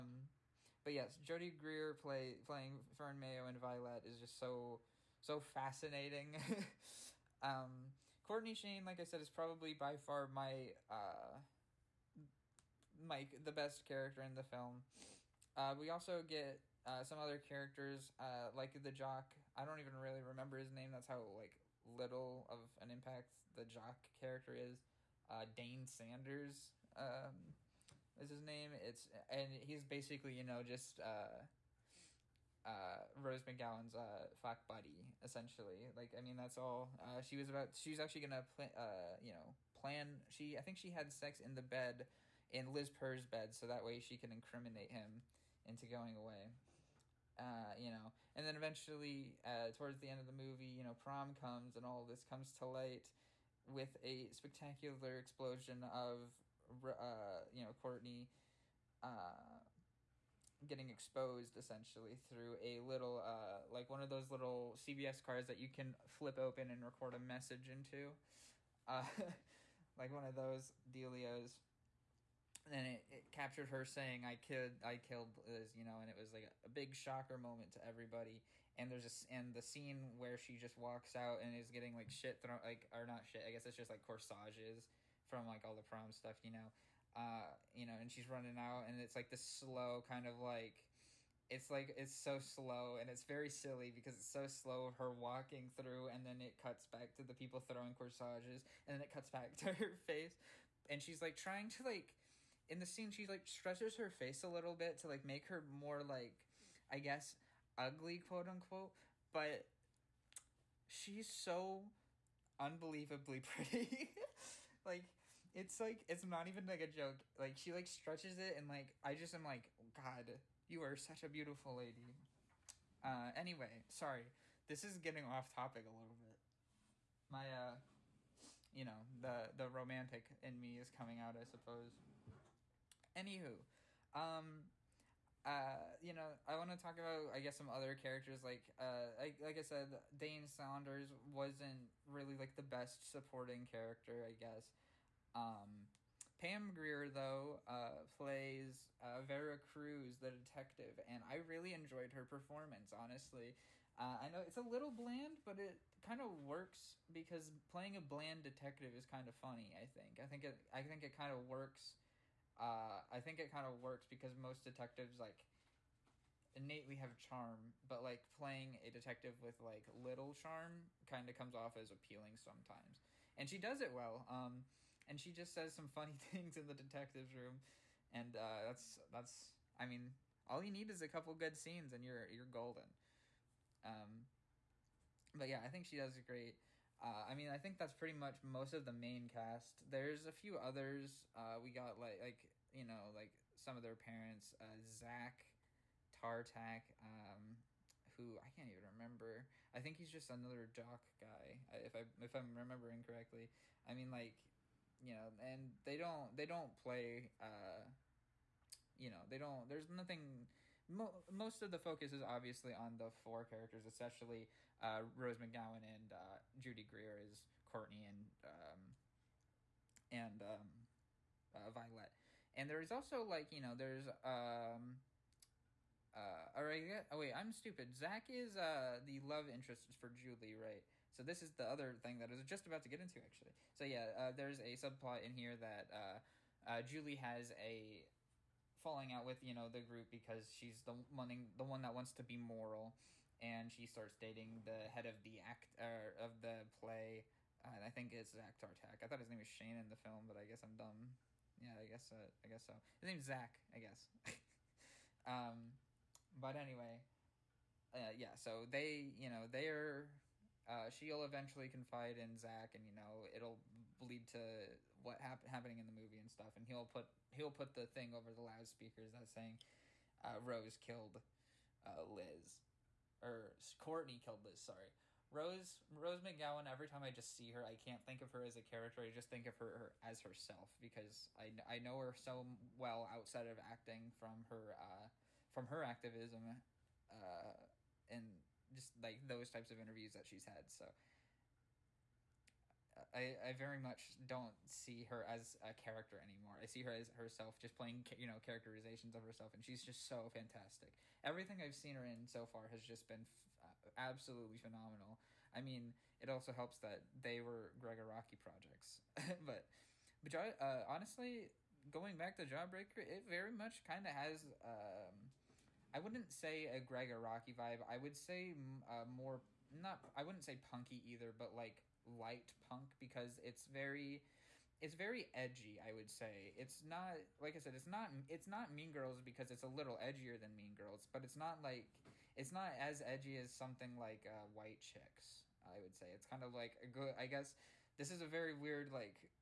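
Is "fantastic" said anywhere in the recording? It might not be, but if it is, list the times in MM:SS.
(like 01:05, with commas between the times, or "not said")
05:00.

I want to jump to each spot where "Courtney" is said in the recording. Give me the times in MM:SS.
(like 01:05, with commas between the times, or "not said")
00:08, 00:57, 03:37, 04:33.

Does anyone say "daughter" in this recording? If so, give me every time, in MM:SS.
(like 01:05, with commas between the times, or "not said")
not said.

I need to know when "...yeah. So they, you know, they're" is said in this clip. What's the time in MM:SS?
04:18.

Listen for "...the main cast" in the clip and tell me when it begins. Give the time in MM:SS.
03:08.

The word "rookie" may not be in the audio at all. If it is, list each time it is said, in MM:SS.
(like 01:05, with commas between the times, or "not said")
not said.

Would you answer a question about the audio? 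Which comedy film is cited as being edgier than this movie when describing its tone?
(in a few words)
White Chicks.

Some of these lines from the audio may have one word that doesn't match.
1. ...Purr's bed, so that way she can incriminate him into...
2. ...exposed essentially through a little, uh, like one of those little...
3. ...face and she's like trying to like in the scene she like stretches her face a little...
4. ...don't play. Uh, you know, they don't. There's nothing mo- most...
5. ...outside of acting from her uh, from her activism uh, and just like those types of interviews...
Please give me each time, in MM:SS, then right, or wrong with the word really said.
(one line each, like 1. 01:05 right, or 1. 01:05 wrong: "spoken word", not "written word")
1. 00:42 right
2. 01:00 right
3. 01:39 right
4. 03:26 right
5. 04:43 right.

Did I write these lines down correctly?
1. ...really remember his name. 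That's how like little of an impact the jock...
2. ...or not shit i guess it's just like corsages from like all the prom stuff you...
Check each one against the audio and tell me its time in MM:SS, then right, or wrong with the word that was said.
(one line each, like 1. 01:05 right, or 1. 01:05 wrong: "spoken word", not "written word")
1. 00:19 right
2. 01:22 right.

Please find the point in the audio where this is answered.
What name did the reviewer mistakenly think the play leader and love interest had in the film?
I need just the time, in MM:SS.
04:09.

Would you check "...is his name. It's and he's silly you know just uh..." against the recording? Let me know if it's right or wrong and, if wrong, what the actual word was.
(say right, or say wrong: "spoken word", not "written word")
wrong: "basically", not "silly".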